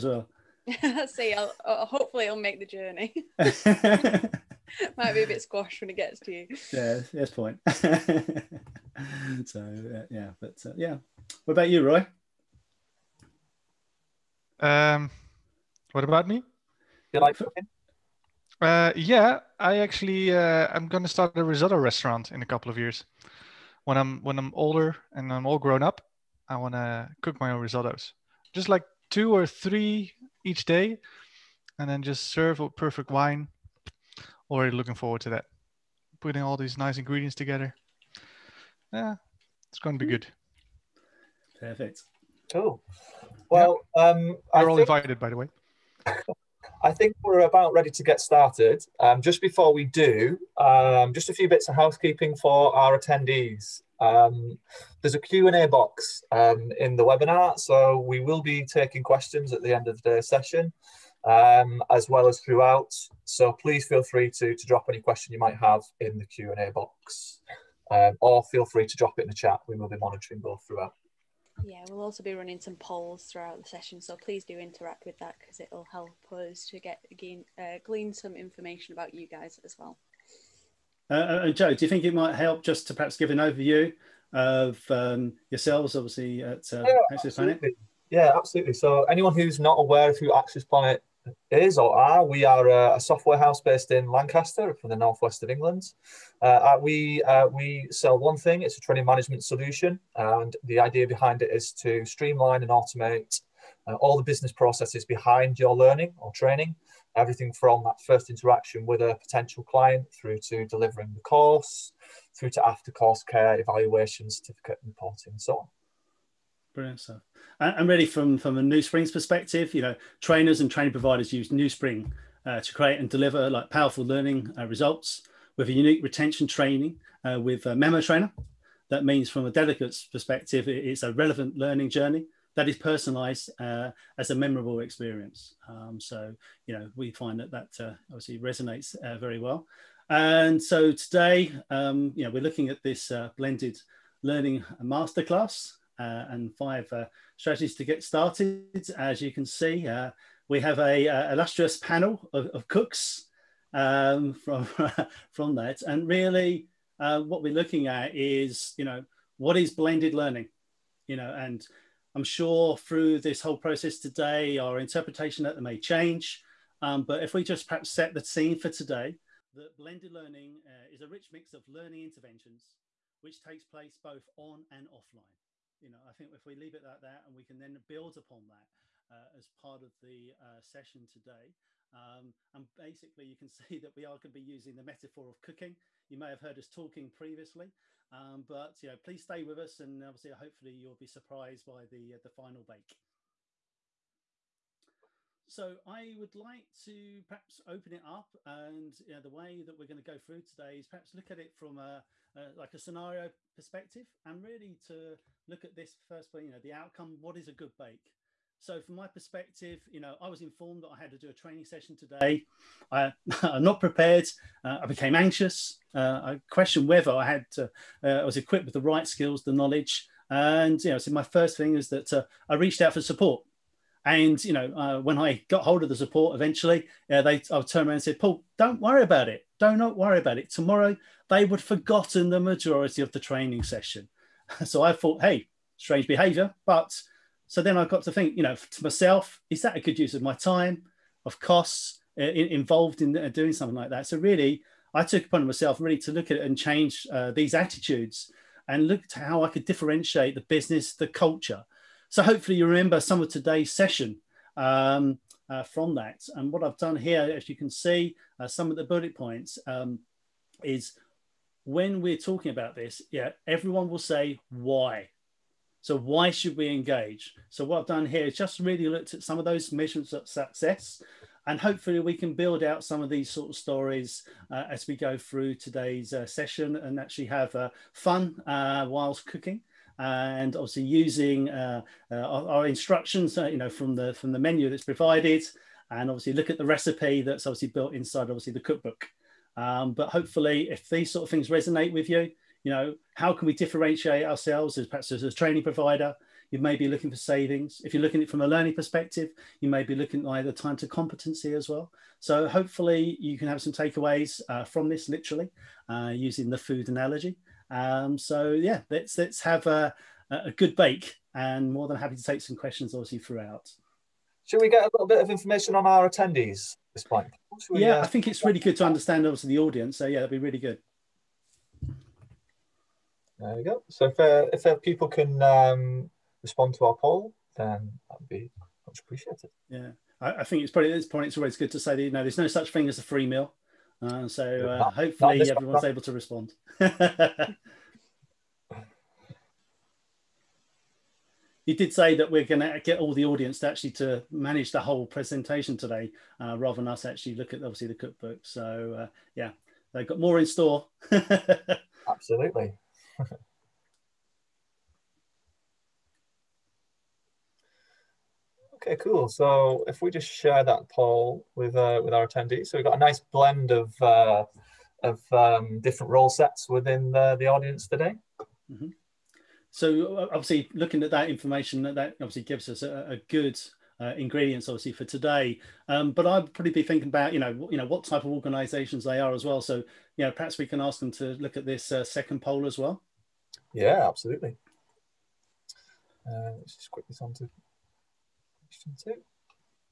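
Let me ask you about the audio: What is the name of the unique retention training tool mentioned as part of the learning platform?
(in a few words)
MemoTrainer.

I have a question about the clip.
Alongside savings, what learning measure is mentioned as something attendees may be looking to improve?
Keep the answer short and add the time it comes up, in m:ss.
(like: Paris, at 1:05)
Time to competency, at 5:00.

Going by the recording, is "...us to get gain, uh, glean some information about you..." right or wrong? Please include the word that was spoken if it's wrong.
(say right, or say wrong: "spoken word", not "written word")
right.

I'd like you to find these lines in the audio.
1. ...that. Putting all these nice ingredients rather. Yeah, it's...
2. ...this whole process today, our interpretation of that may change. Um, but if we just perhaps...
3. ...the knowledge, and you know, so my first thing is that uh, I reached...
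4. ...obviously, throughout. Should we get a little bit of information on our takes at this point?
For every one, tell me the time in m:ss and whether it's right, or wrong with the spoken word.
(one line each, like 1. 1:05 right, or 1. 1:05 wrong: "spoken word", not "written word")
1. 0:35 wrong: "together", not "rather"
2. 2:43 right
3. 3:39 right
4. 5:12 wrong: "attendees", not "takes".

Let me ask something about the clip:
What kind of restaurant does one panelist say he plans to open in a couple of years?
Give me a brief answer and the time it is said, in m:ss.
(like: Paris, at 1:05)
Risotto restaurant, at 0:21.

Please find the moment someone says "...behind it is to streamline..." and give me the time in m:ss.
1:41.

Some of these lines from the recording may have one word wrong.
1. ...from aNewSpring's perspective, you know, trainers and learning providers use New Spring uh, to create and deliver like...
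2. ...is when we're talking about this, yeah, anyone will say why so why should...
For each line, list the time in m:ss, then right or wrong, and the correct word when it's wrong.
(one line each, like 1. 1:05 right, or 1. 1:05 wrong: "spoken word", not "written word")
1. 1:58 wrong: "training", not "learning"
2. 4:20 wrong: "everyone", not "anyone".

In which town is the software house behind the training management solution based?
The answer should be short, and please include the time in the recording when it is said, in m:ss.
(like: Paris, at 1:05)
Lancaster, at 1:34.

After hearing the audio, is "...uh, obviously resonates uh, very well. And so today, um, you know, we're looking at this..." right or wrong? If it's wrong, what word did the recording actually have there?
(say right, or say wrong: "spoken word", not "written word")
right.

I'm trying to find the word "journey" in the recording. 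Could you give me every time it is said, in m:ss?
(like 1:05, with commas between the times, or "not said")
0:02, 2:11.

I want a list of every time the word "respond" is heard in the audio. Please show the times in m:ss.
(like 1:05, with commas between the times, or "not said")
5:26, 5:36.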